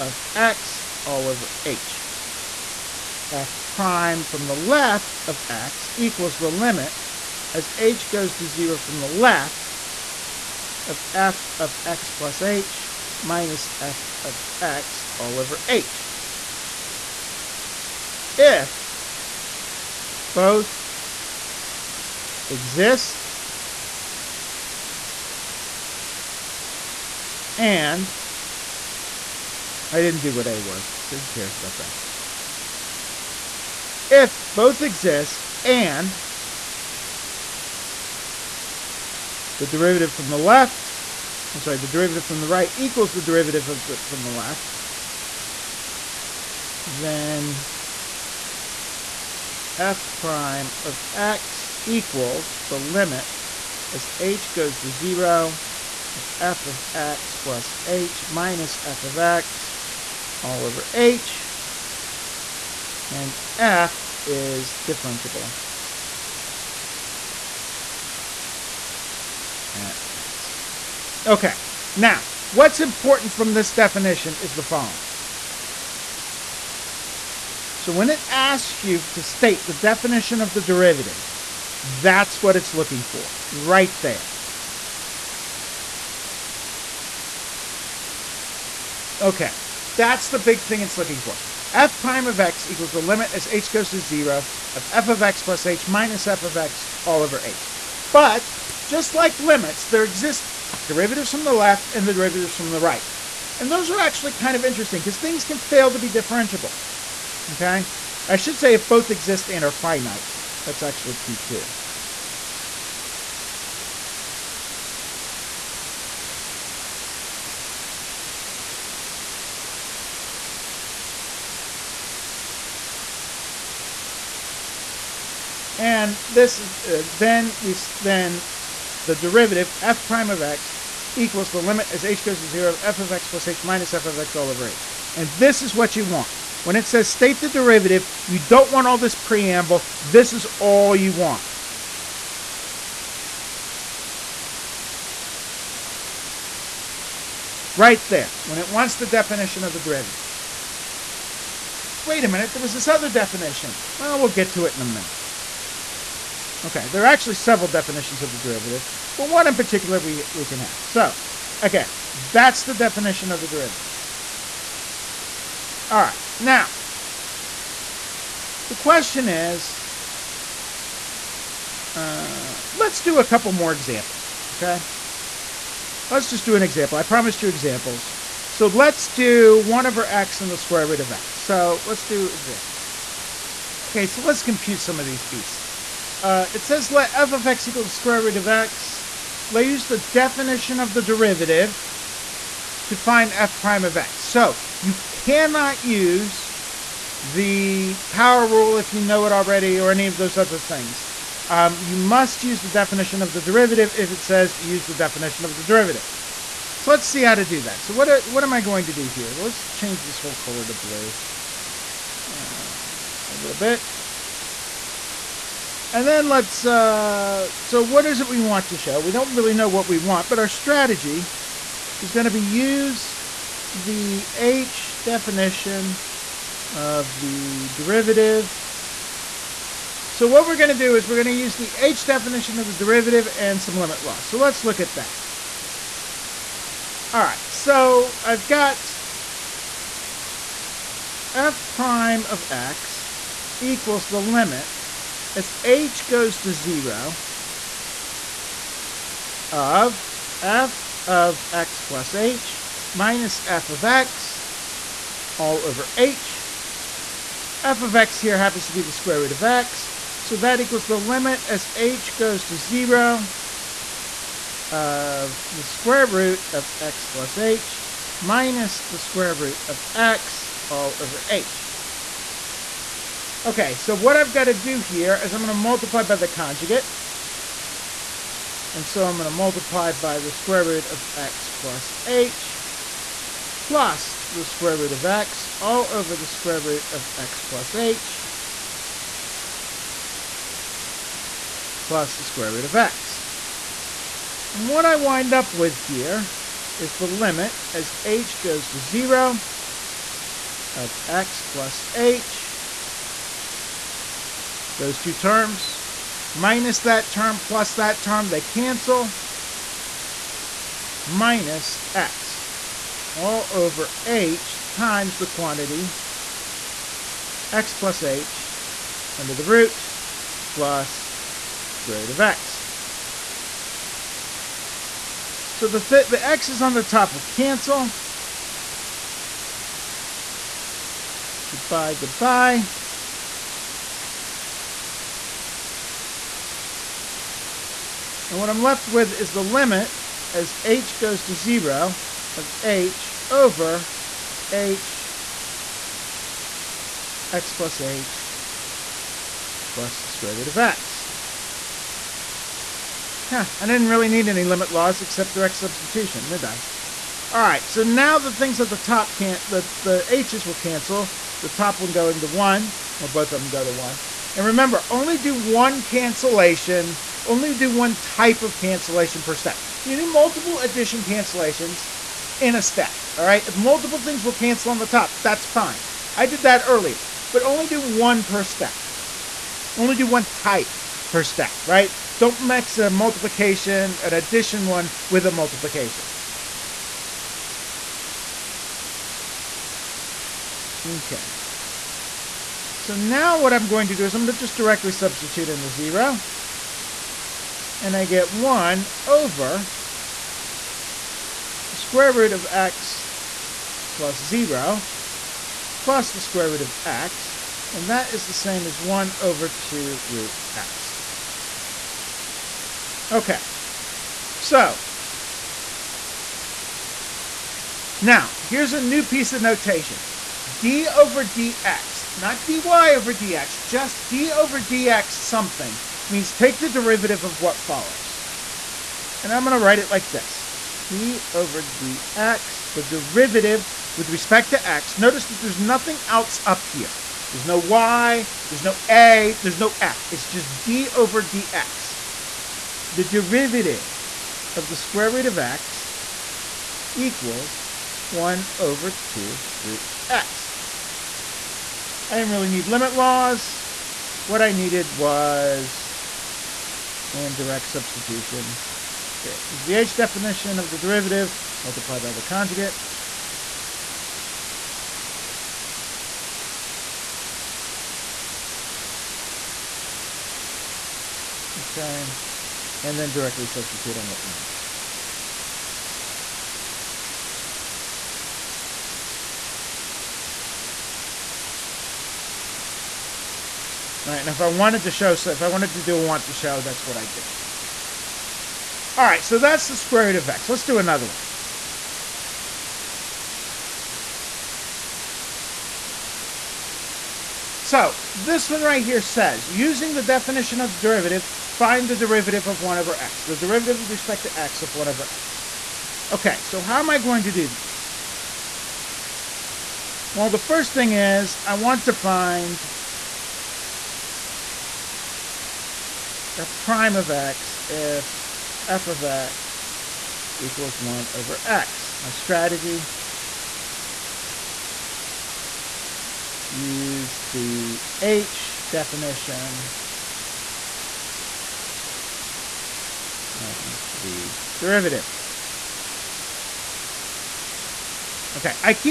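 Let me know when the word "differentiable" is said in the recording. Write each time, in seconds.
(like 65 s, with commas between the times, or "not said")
64 s, 106 s.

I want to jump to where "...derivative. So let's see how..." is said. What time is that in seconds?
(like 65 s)
205 s.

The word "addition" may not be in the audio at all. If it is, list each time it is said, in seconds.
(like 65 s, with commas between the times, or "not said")
370 s, 384 s.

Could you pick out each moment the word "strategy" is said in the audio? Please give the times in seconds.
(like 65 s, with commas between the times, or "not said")
220 s, 522 s.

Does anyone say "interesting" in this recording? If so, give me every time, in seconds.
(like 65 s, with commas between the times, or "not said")
104 s.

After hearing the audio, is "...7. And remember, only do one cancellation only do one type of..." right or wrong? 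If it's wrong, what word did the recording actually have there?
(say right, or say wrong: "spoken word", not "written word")
wrong: "1", not "7".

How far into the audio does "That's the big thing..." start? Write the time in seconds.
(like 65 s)
89 s.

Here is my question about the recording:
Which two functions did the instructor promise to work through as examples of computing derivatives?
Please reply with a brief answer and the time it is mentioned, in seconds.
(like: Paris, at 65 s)
1/x and square root of x, at 179 s.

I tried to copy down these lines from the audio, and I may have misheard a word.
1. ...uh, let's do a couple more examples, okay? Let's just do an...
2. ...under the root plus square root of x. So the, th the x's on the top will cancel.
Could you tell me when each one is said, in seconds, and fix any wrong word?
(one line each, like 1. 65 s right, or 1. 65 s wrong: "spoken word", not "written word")
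1. 171 s right
2. 319 s right.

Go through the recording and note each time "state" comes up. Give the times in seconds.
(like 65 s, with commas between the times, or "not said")
79 s, 137 s.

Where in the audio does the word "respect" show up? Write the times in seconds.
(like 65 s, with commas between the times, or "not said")
434 s, 503 s.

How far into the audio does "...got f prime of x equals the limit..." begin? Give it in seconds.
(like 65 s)
238 s.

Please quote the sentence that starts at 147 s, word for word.
Right there, when it wants the definition of the derivative.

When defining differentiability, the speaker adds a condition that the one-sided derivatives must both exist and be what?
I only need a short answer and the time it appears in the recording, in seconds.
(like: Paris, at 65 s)
finite, at 109 s.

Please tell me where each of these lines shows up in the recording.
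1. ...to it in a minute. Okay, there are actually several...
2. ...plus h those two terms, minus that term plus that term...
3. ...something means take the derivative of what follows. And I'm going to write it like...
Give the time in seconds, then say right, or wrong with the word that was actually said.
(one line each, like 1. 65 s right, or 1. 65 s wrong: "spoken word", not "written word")
1. 154 s right
2. 301 s right
3. 425 s right.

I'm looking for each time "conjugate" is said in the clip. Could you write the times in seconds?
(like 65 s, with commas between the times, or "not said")
276 s, 462 s.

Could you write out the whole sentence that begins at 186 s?
Uh, it says let f of x equal the square root of x.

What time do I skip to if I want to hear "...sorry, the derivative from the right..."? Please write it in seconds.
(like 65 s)
41 s.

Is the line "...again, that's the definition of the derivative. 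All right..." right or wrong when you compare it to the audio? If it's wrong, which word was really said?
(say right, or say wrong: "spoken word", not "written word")
right.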